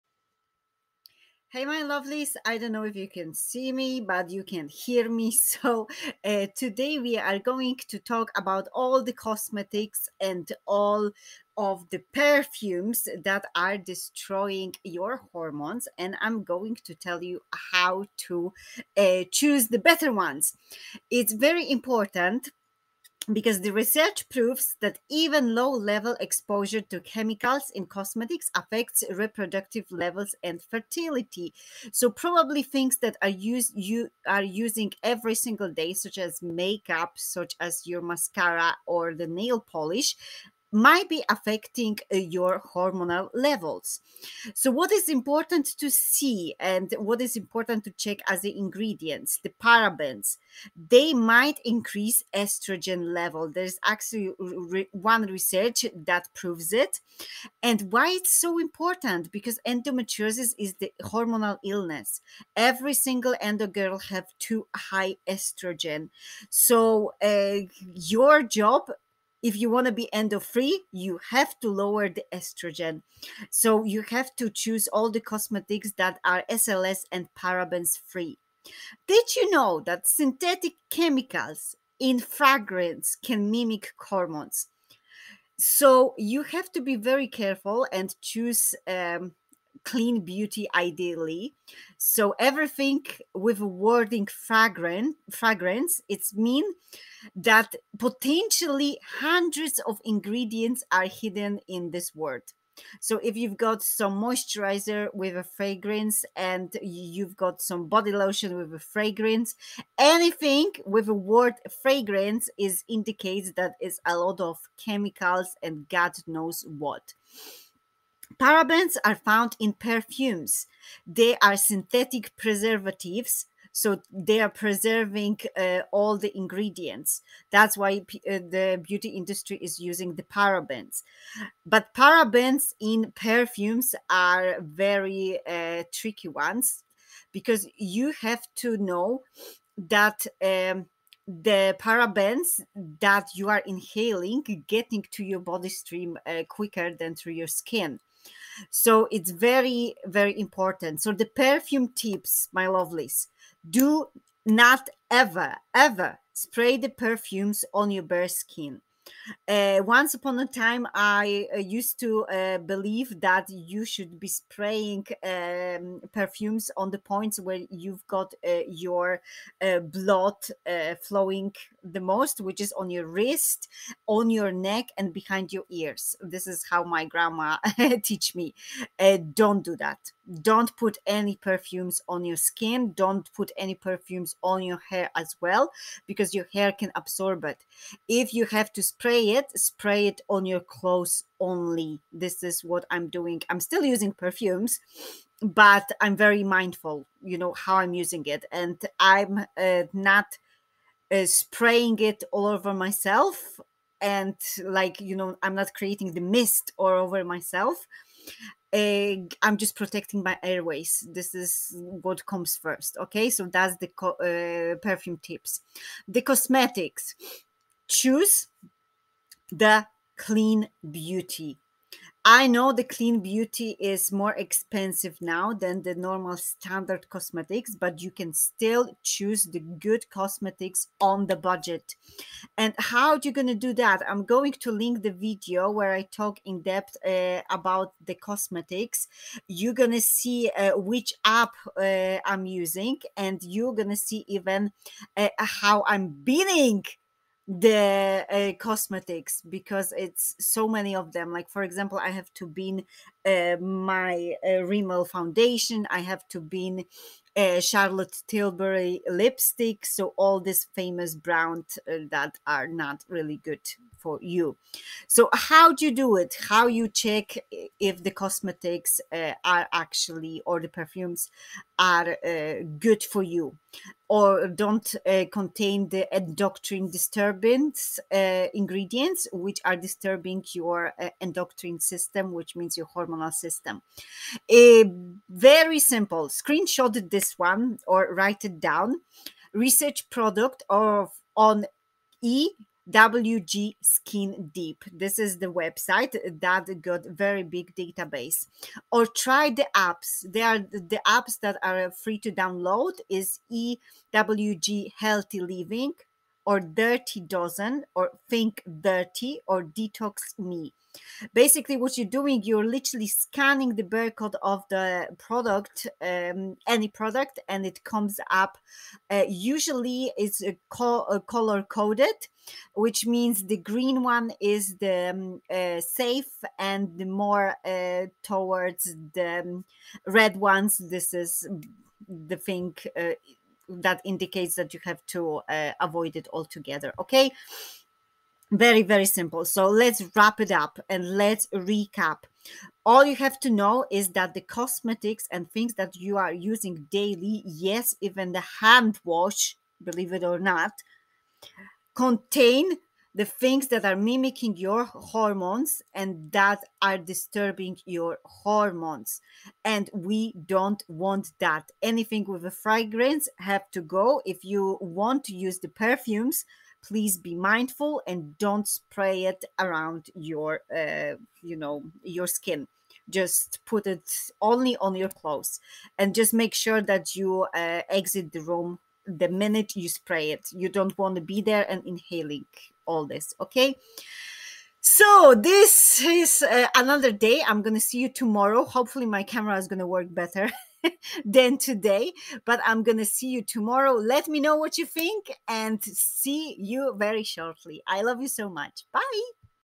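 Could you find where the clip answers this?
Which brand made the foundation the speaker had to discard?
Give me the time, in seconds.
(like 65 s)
254 s.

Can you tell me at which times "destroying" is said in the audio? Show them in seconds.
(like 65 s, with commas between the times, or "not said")
13 s.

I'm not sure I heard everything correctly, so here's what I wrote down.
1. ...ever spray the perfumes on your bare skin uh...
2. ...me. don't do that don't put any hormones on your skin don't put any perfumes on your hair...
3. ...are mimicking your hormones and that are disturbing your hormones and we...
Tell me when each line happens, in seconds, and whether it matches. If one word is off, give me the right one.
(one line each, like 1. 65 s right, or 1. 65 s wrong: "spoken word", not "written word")
1. 155 s right
2. 178 s wrong: "perfumes", not "hormones"
3. 353 s right.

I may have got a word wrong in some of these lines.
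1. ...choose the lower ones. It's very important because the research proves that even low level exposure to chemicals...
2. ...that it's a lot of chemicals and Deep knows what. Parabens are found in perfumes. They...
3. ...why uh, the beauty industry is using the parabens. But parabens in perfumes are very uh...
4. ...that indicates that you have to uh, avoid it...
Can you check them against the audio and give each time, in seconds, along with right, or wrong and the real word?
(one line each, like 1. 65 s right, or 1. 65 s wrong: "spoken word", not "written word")
1. 19 s wrong: "better", not "lower"
2. 113 s wrong: "God", not "Deep"
3. 127 s right
4. 333 s right.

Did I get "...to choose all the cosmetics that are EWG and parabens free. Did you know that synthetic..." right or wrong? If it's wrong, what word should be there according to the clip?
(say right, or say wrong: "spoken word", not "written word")
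wrong: "SLS", not "EWG".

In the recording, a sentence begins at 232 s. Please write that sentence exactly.
And how you're going to do that?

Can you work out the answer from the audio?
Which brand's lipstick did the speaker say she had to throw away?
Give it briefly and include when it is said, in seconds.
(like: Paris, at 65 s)
Charlotte Tilbury, at 257 s.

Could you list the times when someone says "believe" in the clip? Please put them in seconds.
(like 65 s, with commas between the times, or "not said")
162 s, 349 s.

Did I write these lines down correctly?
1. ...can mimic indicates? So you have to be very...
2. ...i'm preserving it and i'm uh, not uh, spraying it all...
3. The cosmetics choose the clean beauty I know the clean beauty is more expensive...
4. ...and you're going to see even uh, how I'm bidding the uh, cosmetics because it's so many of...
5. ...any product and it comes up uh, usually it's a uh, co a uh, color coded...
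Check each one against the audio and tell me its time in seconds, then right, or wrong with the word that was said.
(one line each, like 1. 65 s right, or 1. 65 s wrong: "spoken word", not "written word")
1. 83 s wrong: "hormones", not "indicates"
2. 197 s wrong: "using", not "preserving"
3. 216 s right
4. 243 s right
5. 316 s right.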